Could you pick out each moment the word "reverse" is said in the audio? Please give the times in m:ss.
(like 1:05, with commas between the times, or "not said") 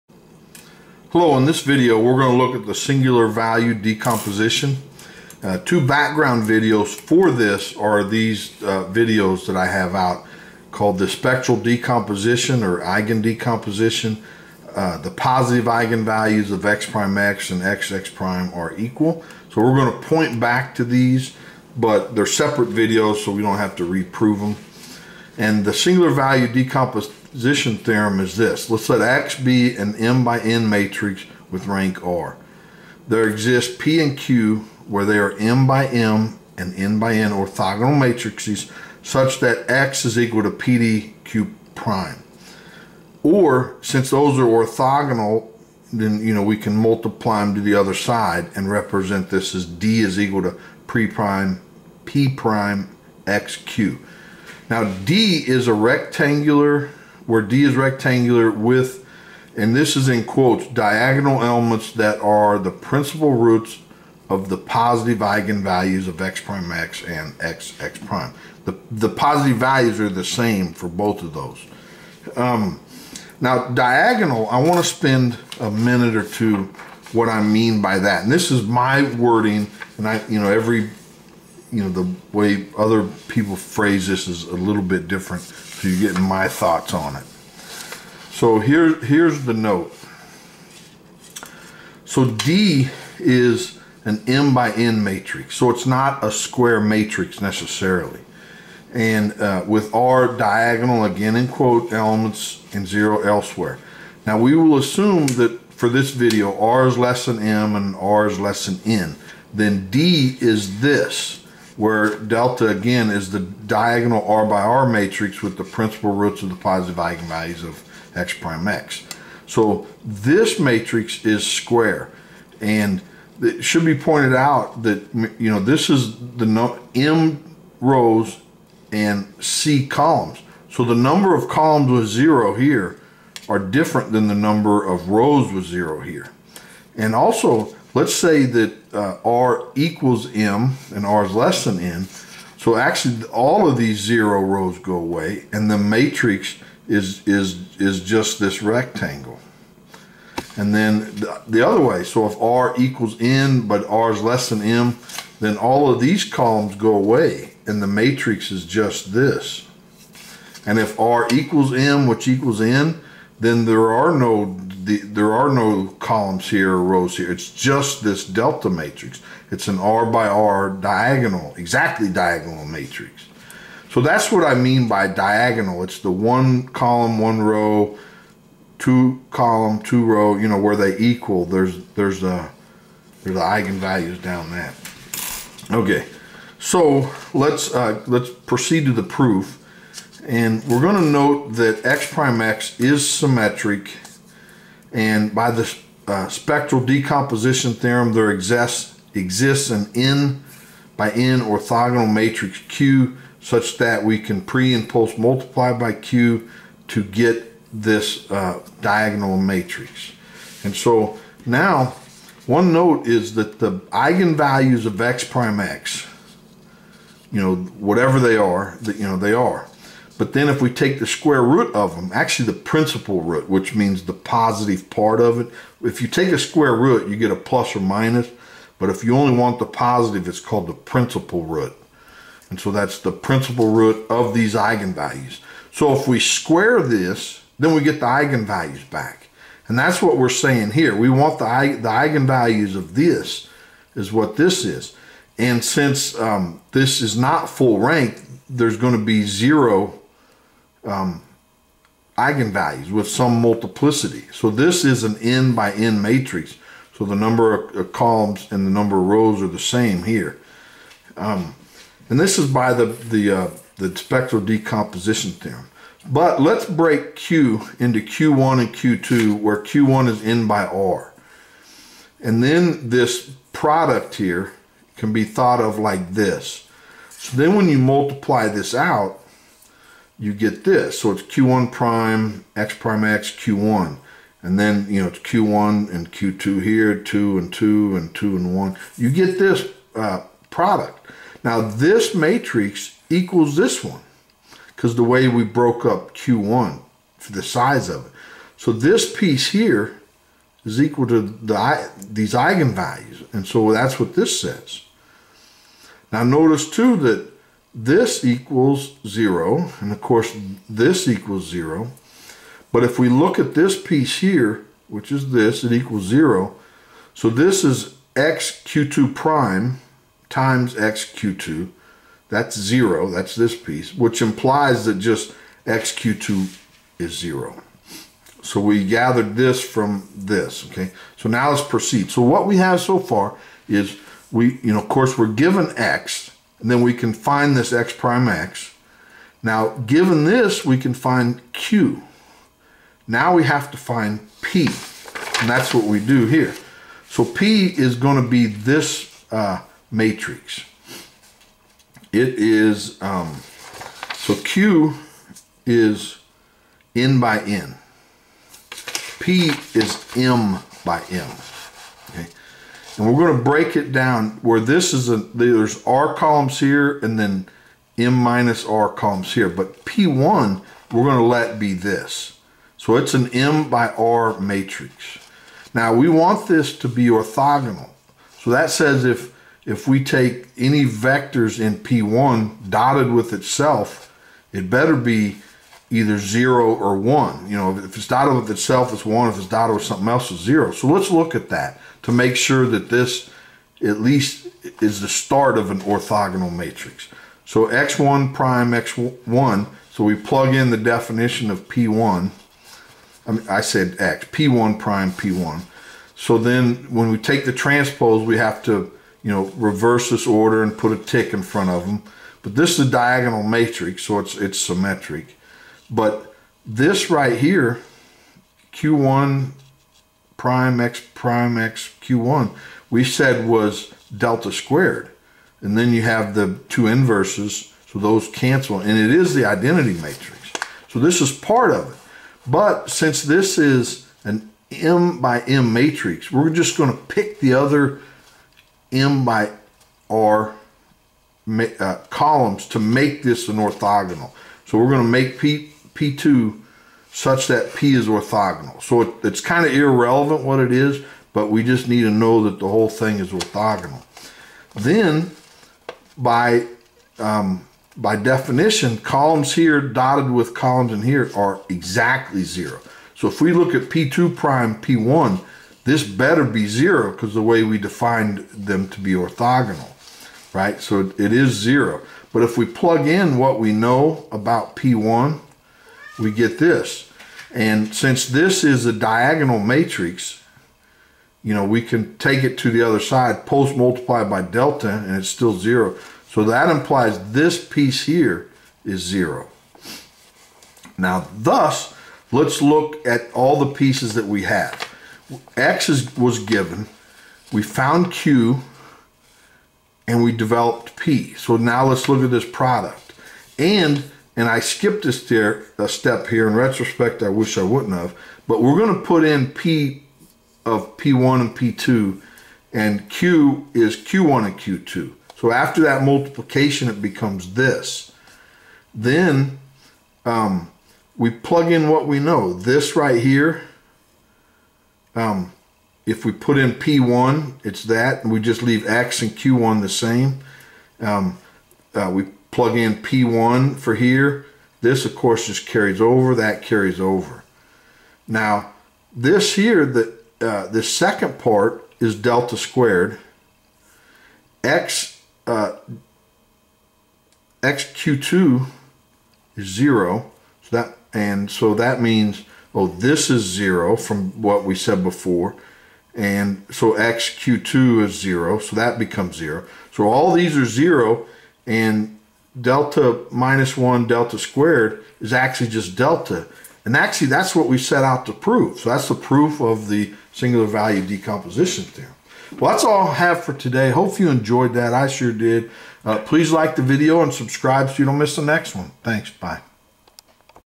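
6:49.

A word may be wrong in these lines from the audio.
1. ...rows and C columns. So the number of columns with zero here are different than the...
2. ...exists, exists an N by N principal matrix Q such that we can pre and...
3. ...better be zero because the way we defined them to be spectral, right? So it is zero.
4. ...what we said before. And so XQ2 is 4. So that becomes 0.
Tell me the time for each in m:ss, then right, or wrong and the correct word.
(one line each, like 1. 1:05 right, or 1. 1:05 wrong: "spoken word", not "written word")
1. 2:07 right
2. 3:18 wrong: "orthogonal", not "principal"
3. 7:46 wrong: "orthogonal", not "spectral"
4. 9:14 wrong: "0", not "4".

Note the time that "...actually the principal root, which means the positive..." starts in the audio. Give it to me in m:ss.
3:42.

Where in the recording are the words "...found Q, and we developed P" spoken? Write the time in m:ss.
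8:17.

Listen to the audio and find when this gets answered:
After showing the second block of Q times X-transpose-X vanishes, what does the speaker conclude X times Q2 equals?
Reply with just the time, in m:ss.
5:25.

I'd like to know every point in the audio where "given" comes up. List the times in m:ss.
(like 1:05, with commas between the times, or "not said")
5:35, 5:39, 8:16.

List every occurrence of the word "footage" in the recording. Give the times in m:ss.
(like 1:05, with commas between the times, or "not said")
not said.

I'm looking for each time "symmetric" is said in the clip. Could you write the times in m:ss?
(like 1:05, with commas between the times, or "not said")
3:13, 6:54.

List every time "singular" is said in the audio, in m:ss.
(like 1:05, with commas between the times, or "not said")
0:02, 0:25, 9:30.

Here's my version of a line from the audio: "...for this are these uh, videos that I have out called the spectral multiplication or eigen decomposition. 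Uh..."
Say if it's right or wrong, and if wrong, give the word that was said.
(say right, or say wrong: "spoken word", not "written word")
wrong: "decomposition", not "multiplication".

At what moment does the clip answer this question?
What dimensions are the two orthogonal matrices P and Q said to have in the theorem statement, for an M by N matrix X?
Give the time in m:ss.
0:35.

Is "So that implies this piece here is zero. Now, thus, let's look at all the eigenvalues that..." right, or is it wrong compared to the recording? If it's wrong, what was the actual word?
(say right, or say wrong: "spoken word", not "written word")
wrong: "pieces", not "eigenvalues".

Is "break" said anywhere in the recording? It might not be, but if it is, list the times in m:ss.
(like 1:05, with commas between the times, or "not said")
4:26, 6:03.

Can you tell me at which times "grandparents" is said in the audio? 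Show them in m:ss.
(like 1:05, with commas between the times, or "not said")
not said.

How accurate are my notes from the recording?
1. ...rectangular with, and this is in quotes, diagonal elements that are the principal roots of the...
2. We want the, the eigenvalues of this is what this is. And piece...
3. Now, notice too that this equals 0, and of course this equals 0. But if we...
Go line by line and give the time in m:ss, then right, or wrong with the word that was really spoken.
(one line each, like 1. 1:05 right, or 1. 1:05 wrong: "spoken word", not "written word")
1. 0:57 right
2. 4:00 wrong: "since", not "piece"
3. 5:06 right.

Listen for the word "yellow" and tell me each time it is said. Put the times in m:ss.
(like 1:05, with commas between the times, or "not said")
not said.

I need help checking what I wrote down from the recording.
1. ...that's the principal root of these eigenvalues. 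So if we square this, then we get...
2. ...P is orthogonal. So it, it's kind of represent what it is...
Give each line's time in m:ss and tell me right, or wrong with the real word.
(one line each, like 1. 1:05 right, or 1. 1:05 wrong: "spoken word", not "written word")
1. 3:52 right
2. 7:27 wrong: "irrelevant", not "represent".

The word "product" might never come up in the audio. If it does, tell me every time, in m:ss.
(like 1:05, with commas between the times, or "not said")
4:33, 4:50, 8:22.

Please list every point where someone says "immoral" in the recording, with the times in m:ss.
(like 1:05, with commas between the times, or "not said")
not said.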